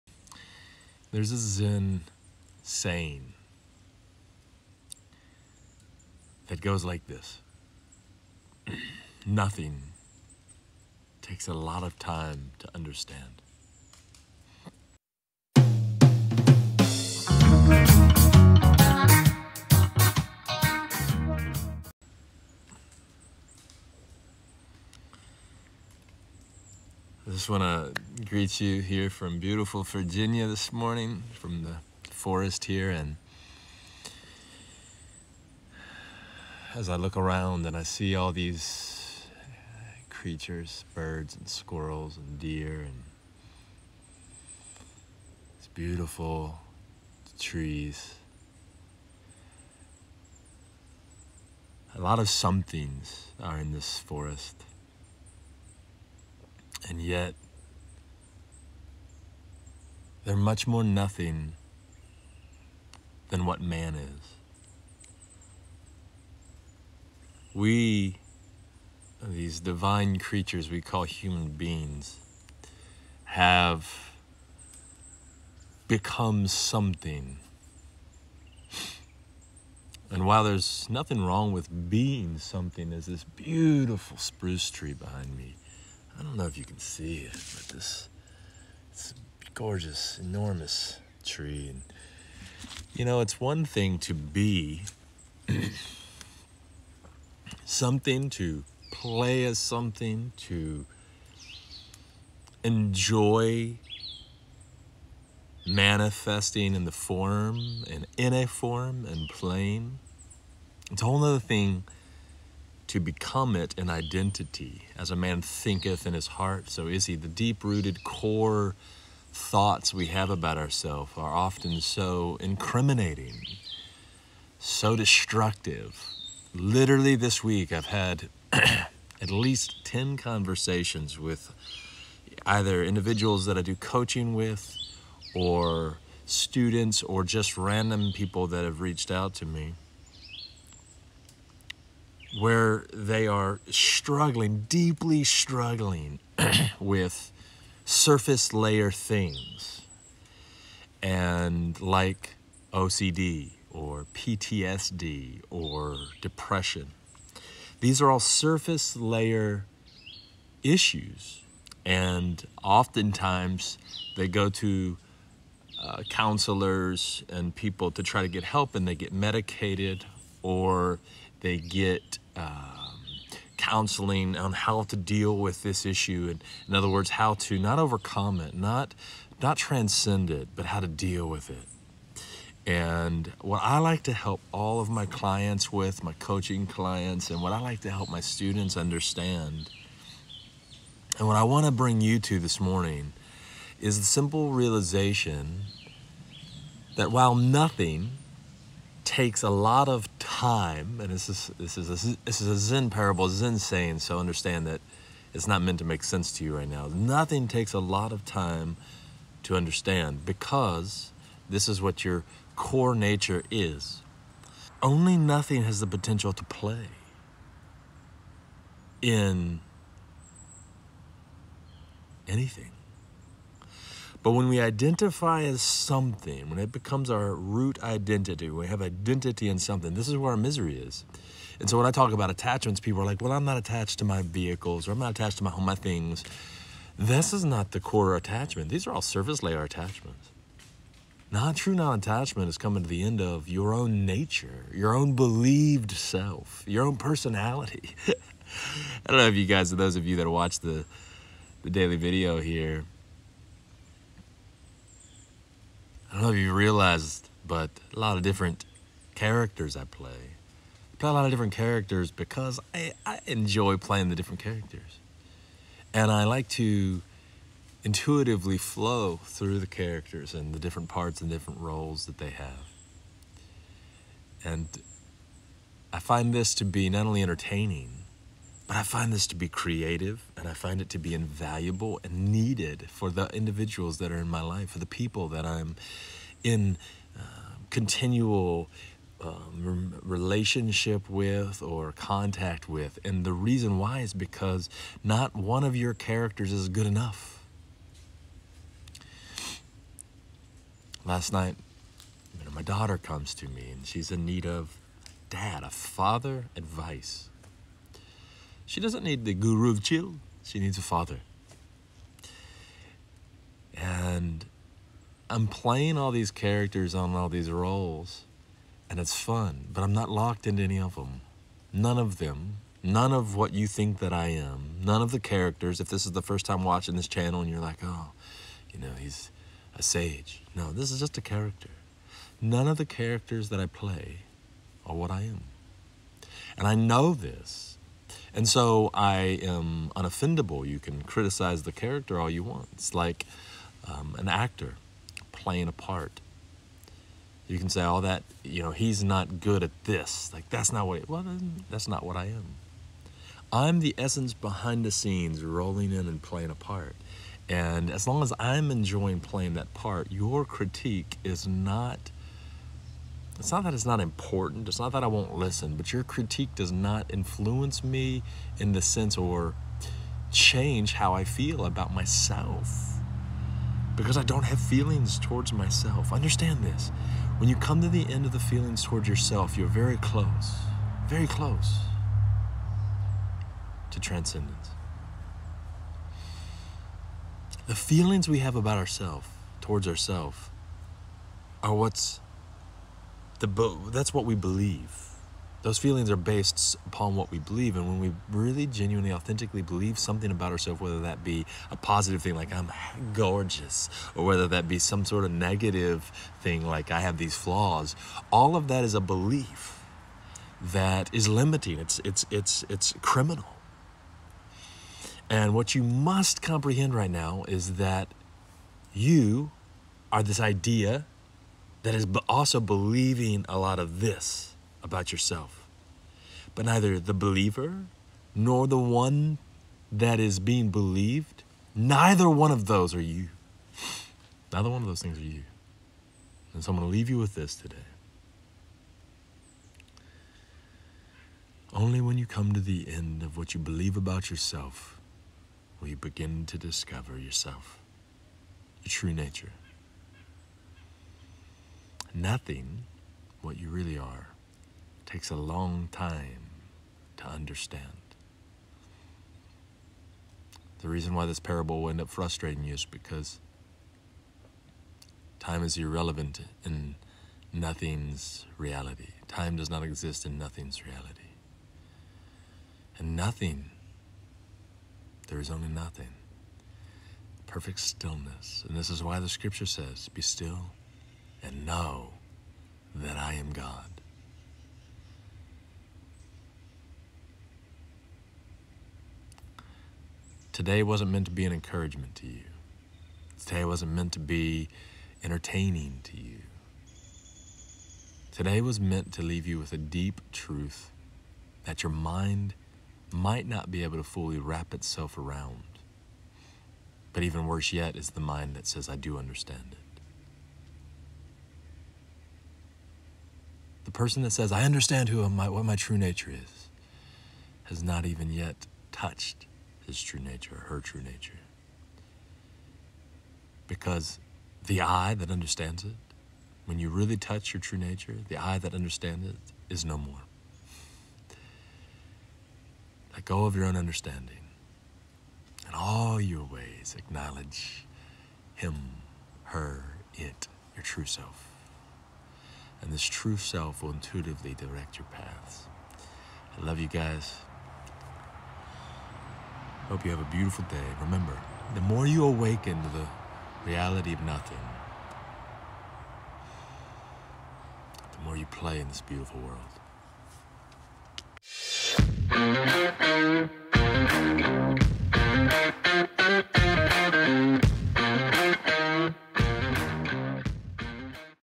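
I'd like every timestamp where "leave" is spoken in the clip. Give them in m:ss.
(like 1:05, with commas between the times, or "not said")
7:16, 8:19.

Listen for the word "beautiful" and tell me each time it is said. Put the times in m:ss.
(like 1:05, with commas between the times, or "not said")
0:29, 0:45, 1:23, 9:10, 9:19.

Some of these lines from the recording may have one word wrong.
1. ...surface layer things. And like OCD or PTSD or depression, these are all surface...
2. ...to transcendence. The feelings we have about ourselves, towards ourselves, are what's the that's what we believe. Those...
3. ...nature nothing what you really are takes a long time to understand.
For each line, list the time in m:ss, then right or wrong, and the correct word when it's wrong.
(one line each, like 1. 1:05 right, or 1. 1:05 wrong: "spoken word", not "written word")
1. 2:27 right
2. 6:23 right
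3. 7:29 right.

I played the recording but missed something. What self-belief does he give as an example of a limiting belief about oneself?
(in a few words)
I'm gorgeous.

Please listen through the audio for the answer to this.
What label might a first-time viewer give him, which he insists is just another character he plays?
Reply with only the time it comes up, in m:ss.
5:29.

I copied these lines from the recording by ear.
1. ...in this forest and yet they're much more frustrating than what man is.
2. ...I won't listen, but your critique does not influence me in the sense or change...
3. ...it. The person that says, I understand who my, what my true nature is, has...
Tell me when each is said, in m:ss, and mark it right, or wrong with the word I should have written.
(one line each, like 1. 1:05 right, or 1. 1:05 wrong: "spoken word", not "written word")
1. 0:53 wrong: "nothing", not "frustrating"
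2. 6:05 right
3. 8:29 right.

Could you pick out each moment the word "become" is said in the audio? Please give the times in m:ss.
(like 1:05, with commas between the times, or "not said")
1:15, 1:52, 3:46.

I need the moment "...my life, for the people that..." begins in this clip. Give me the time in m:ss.
4:44.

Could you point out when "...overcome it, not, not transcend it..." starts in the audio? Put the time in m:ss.
2:57.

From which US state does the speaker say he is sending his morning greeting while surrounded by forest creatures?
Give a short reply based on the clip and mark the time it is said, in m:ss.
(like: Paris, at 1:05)
Virginia, at 0:29.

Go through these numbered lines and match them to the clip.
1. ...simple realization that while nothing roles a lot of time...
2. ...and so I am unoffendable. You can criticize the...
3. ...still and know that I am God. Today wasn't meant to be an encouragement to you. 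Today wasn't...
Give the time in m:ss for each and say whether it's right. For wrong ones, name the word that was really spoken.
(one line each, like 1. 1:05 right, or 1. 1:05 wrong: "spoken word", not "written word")
1. 3:14 wrong: "takes", not "roles"
2. 5:38 right
3. 8:00 right.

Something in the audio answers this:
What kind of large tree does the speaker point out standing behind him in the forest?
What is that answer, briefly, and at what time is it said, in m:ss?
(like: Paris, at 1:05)
Spruce, at 1:24.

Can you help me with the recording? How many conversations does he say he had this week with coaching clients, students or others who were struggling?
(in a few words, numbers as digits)
10.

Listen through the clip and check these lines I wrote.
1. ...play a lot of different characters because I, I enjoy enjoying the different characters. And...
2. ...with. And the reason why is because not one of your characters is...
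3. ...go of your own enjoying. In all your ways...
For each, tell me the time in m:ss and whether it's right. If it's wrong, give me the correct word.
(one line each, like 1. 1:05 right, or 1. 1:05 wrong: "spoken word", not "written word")
1. 4:20 wrong: "playing", not "enjoying"
2. 4:52 right
3. 8:53 wrong: "understanding", not "enjoying".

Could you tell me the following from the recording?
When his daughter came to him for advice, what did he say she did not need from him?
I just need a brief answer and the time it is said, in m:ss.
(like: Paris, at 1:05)
The guru of chill, at 5:09.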